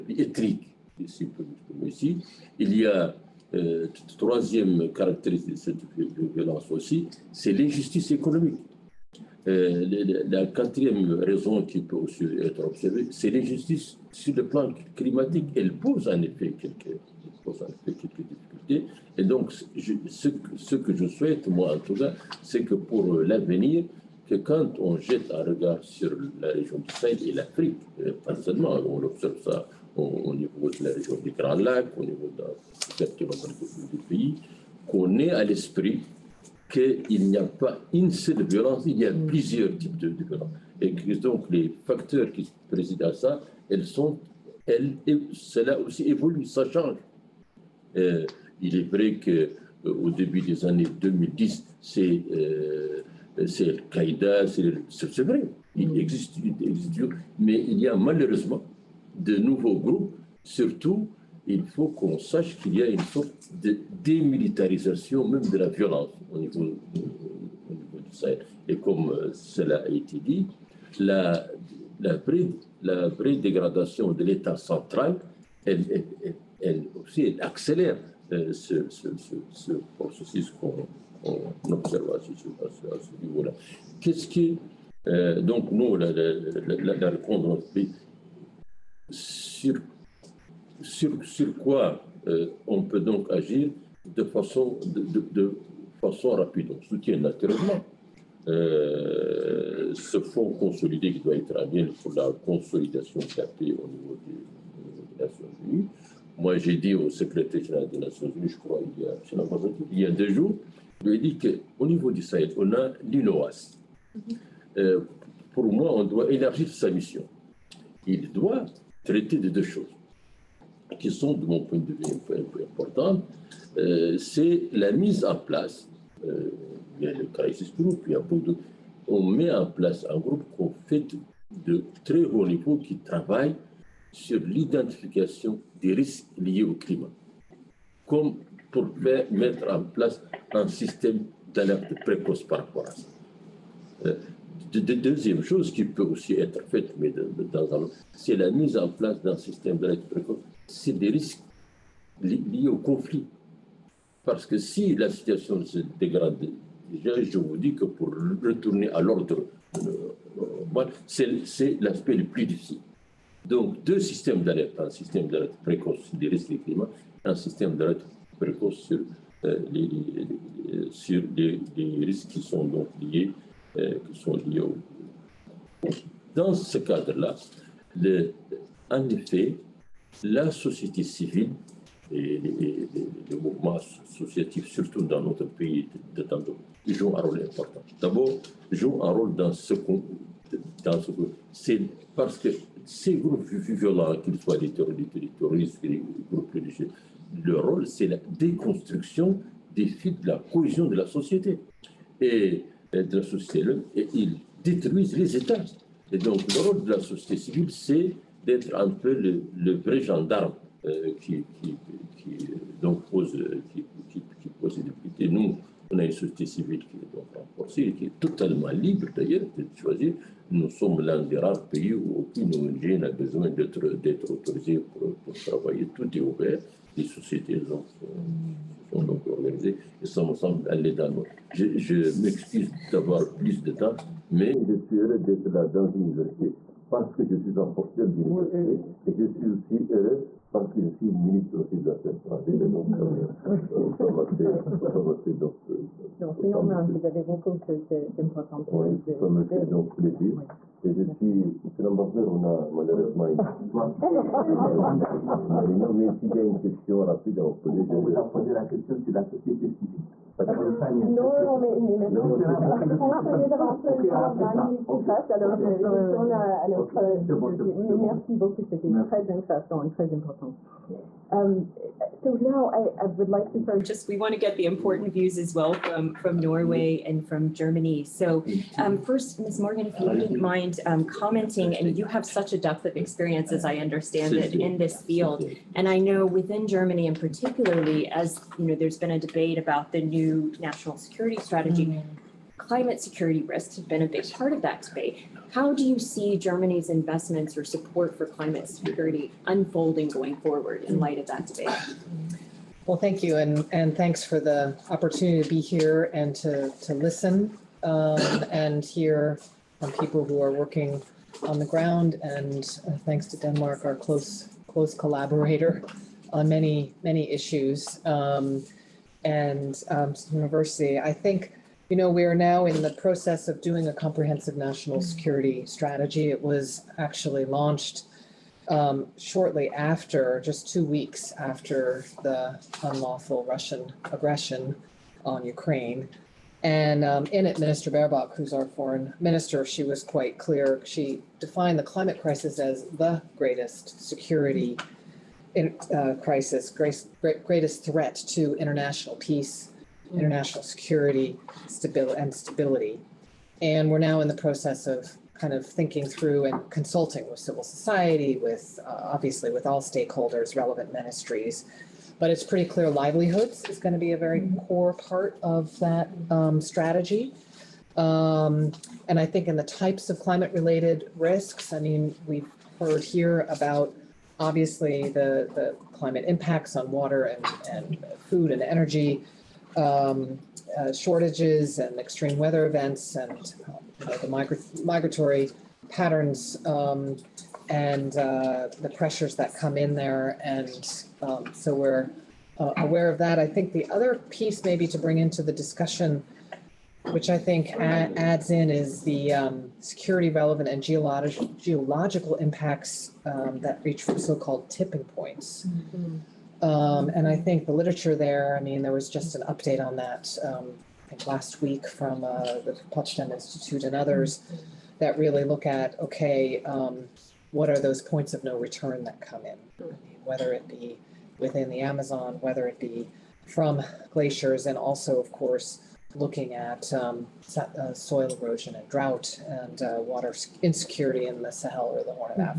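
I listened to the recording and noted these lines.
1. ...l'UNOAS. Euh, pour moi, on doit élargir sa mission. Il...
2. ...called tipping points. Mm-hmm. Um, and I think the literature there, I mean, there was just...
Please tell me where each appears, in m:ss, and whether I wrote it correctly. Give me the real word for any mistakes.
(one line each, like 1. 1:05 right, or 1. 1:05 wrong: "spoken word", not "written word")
1. 1:53 right
2. 6:44 right.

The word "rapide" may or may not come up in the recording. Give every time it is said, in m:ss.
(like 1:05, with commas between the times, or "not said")
1:36, 4:16.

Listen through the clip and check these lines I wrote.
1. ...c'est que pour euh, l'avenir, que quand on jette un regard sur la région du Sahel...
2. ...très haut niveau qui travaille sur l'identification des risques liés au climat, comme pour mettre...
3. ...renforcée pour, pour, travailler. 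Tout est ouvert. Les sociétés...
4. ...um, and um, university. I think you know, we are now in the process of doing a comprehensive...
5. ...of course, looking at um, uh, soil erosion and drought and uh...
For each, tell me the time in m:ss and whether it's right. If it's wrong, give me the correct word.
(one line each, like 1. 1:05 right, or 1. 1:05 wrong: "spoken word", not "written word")
1. 0:22 right
2. 2:12 right
3. 3:44 wrong: "autorisée", not "renforcée"
4. 5:18 right
5. 7:05 right.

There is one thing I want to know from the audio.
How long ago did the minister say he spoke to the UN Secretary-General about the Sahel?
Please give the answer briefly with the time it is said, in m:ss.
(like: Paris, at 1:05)
2 days, at 1:50.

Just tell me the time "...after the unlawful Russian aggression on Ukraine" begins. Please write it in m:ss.
5:31.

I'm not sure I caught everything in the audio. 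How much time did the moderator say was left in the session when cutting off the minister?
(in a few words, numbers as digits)
20 minutes.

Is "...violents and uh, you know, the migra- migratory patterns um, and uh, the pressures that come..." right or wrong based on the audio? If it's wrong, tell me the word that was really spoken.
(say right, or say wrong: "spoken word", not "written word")
wrong: "events", not "violents".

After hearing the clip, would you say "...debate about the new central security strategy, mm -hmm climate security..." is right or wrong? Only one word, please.
wrong.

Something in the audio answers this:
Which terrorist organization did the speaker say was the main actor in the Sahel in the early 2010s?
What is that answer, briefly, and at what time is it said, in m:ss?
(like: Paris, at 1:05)
Al-Qaïda, at 0:53.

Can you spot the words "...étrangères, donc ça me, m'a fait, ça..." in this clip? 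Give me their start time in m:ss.
4:02.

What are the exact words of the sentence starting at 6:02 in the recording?
But it's pretty clear livelihoods is going to be a very mm-hmm.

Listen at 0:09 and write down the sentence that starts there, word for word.
Euh, la, quatrième raison qui peut aussi être observée, c'est l'injustice sur le plan climatique.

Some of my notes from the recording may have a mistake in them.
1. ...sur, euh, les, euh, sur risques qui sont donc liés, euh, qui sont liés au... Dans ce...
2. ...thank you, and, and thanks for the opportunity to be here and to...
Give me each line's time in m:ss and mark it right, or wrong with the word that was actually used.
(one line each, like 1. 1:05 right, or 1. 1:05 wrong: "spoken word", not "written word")
1. 2:48 right
2. 5:02 right.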